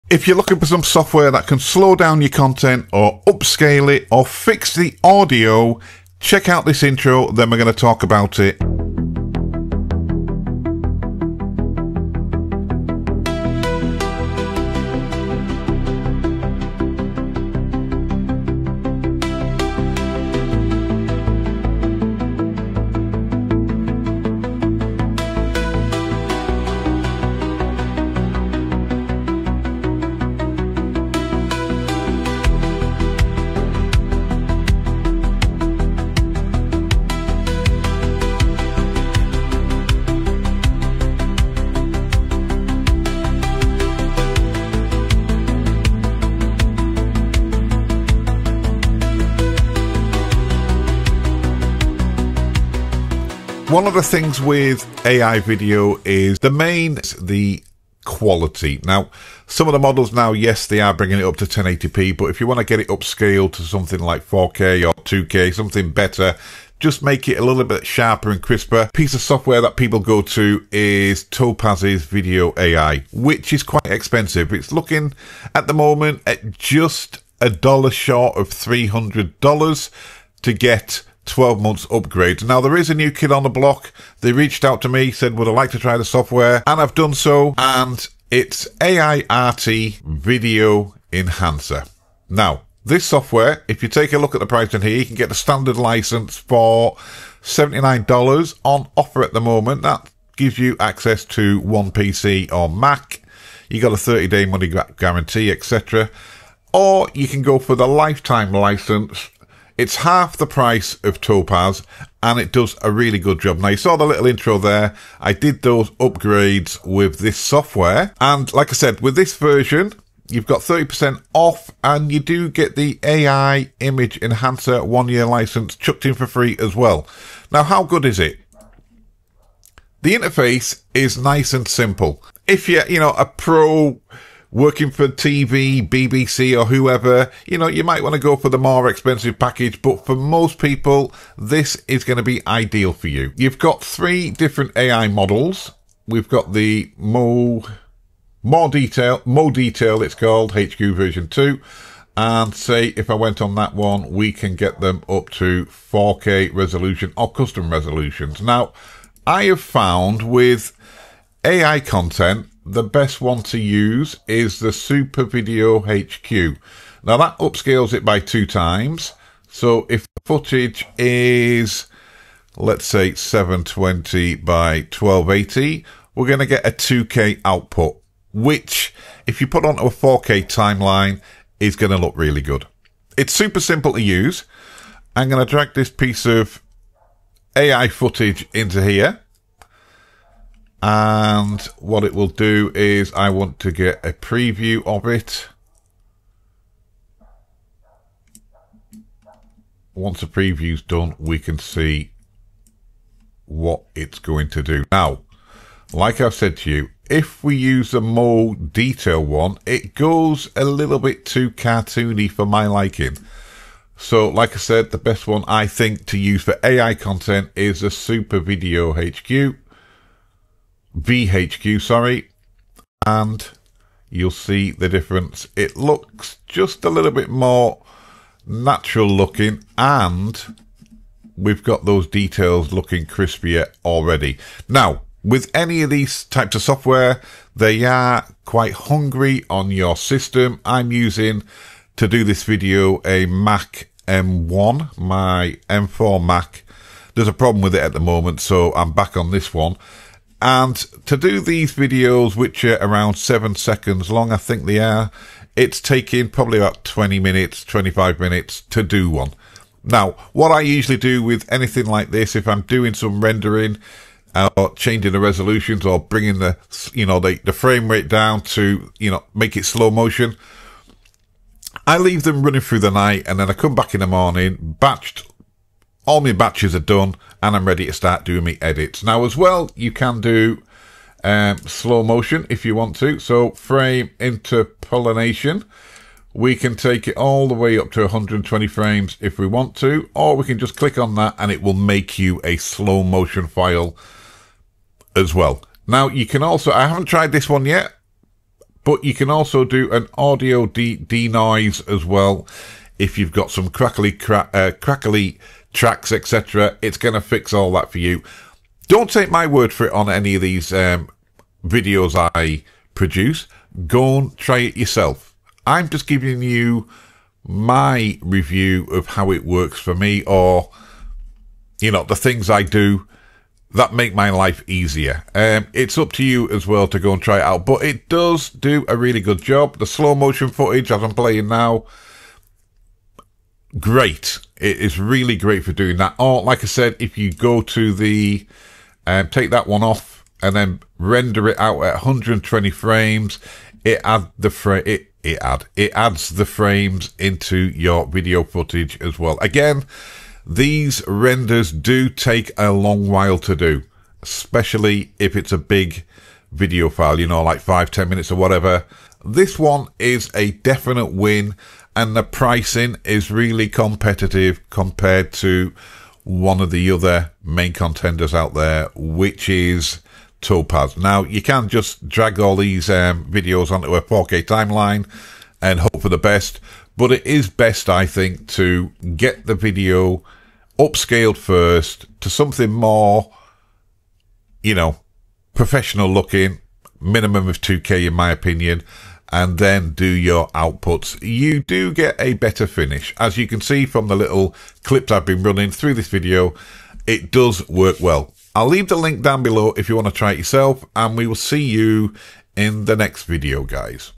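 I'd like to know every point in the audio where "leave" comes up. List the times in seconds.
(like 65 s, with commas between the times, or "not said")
271 s, 398 s.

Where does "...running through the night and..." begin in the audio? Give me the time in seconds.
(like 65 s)
272 s.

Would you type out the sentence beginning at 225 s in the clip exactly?
It looks just a little bit more natural looking and we've got those details looking crispier already.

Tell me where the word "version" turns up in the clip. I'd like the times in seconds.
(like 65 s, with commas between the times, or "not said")
119 s, 150 s.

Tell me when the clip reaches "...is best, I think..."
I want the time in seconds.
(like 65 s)
377 s.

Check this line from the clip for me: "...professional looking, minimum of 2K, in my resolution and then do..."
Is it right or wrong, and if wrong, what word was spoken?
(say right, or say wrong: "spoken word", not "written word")
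wrong: "opinion", not "resolution".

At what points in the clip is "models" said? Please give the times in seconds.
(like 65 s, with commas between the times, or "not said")
59 s, 145 s.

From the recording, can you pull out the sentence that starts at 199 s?
Once the preview's done, we can see what it's going to do.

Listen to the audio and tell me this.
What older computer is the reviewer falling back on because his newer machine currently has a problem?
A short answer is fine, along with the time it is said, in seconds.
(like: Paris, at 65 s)
Mac M1, at 243 s.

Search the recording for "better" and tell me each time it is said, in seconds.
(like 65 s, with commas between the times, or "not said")
65 s, 392 s.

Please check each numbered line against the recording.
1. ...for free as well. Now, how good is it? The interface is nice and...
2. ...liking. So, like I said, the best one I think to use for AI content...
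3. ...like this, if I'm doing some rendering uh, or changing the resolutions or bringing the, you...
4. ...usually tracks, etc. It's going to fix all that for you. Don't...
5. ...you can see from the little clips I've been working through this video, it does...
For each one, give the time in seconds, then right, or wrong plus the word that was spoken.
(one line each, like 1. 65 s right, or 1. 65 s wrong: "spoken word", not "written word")
1. 126 s right
2. 212 s right
3. 261 s right
4. 304 s wrong: "crackly", not "usually"
5. 393 s wrong: "running", not "working".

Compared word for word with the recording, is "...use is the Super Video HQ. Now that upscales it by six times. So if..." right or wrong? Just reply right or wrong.
wrong.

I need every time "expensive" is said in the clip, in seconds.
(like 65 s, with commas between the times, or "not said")
73 s, 138 s.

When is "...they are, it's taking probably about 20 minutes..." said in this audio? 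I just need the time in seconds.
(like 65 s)
254 s.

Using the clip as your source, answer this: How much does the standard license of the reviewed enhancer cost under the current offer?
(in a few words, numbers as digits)
$79.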